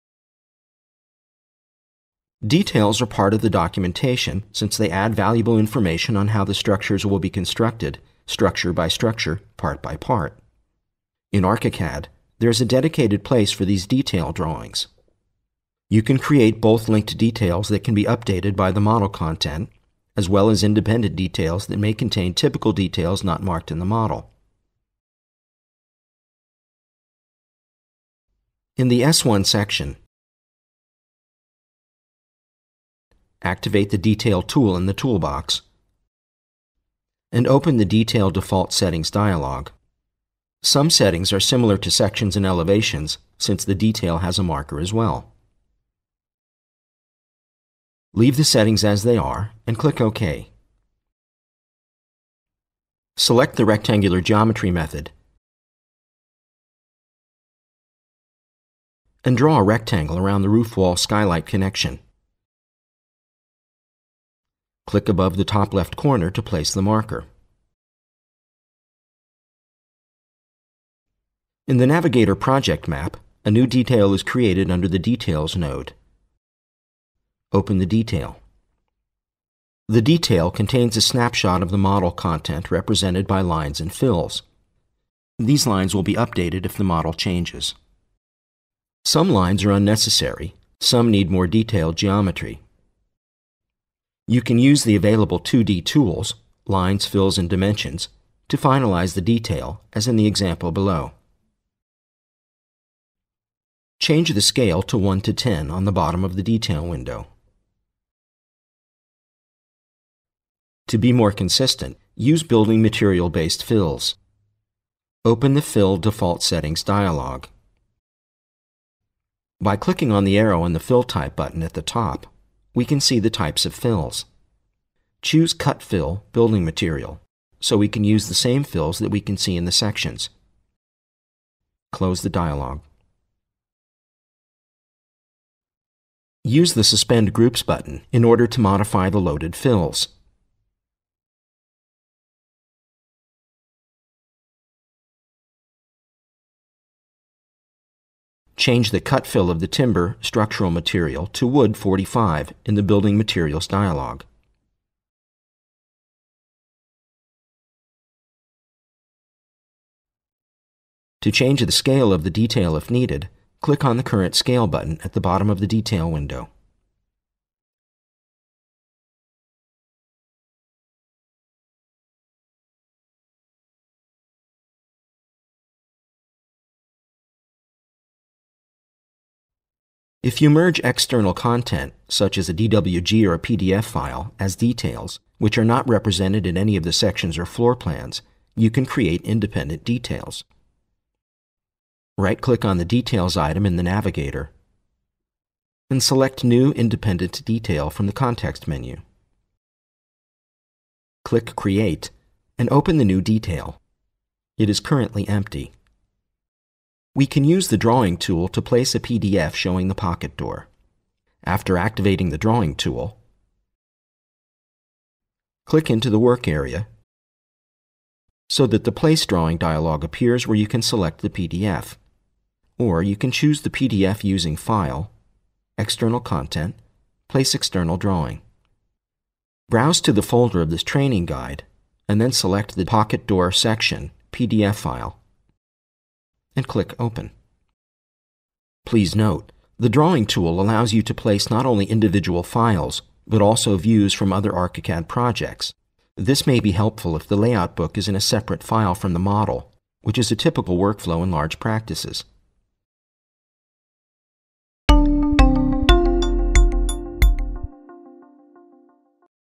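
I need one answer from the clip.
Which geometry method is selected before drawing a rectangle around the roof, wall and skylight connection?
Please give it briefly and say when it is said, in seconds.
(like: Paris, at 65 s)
Rectangular, at 53 s.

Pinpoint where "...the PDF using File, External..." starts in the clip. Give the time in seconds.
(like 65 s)
223 s.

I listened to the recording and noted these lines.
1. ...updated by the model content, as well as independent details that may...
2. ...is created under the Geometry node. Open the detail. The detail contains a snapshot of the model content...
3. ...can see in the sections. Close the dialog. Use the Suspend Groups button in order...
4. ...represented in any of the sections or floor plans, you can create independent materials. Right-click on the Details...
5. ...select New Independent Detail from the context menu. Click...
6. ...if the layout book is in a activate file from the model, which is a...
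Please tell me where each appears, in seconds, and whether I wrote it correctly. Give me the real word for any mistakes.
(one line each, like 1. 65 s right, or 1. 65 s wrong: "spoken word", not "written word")
1. 18 s right
2. 74 s wrong: "Details", not "Geometry"
3. 129 s right
4. 185 s wrong: "details", not "materials"
5. 196 s right
6. 247 s wrong: "separate", not "activate".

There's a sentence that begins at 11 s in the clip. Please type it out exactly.
In ArchiCAD, there is a dedicated place for these detail drawings.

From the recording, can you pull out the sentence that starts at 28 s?
In the S1 section, activate the Detail tool in the toolbox, and open the Detail Default Settings dialog.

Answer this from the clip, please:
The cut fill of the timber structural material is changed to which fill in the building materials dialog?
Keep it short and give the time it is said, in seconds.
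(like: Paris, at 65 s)
wood 45, at 151 s.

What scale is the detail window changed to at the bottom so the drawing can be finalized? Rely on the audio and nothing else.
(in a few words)
1:10.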